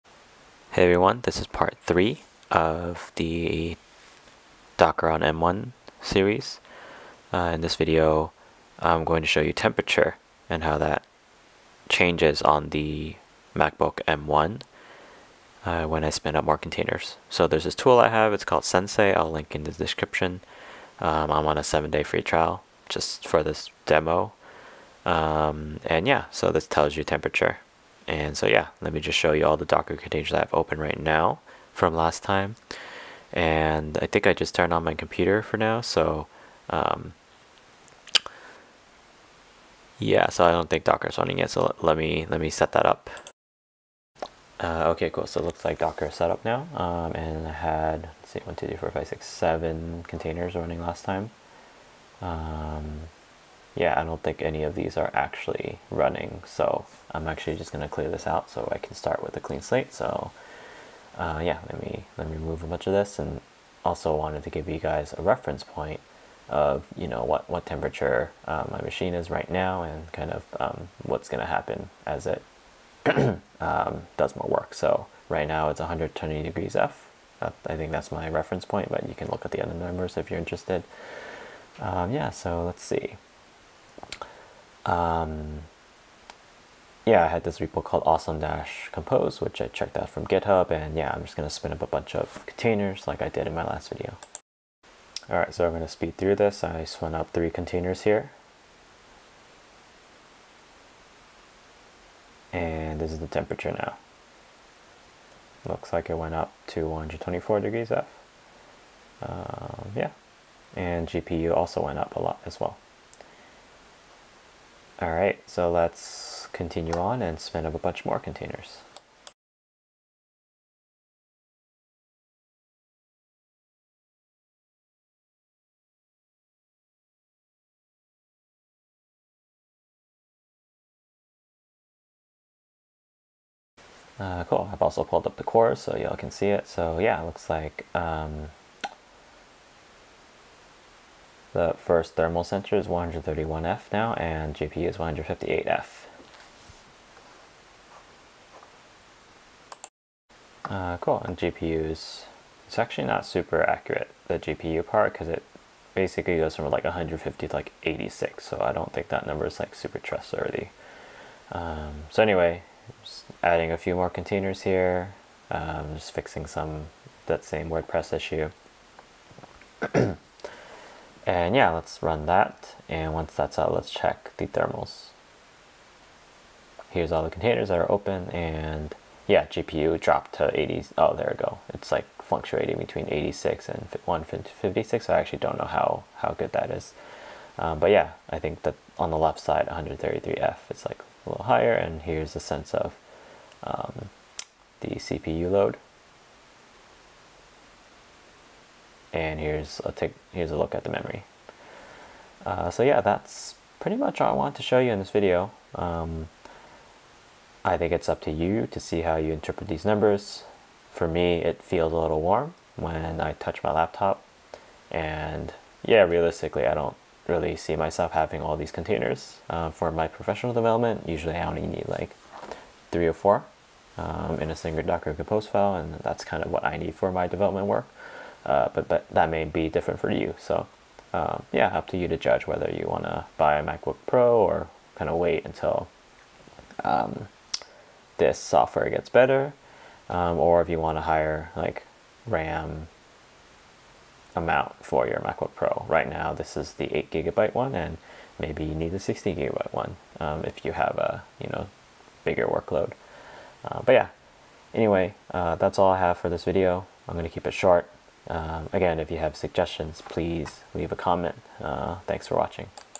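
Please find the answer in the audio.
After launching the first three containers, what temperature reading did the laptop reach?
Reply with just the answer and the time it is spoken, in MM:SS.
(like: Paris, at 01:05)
124 degrees F, at 01:46.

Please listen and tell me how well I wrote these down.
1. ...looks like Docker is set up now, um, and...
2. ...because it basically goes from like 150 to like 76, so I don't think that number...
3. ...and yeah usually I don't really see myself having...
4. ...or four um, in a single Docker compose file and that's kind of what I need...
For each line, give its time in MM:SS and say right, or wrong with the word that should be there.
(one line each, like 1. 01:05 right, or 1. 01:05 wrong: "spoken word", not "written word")
1. 00:45 right
2. 02:35 wrong: "86", not "76"
3. 03:34 wrong: "realistically", not "usually"
4. 03:43 right.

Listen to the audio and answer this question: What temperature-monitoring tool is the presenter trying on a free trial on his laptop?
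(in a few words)
Sensei.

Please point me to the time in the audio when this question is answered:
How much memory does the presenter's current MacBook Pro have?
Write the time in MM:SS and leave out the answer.
04:06.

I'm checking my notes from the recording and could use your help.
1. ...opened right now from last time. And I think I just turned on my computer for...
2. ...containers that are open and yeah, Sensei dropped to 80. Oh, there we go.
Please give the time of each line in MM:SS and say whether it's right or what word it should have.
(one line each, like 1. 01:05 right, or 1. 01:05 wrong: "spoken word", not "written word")
1. 00:30 right
2. 02:57 wrong: "GPU", not "Sensei".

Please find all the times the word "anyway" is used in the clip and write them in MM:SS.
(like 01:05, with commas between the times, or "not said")
02:42, 04:14.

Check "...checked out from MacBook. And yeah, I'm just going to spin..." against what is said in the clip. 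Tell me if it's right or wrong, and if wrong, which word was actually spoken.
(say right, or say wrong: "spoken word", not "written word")
wrong: "GitHub", not "MacBook".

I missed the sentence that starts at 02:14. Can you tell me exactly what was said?
Uh, cool, I've also pulled up the core so y'all can see it.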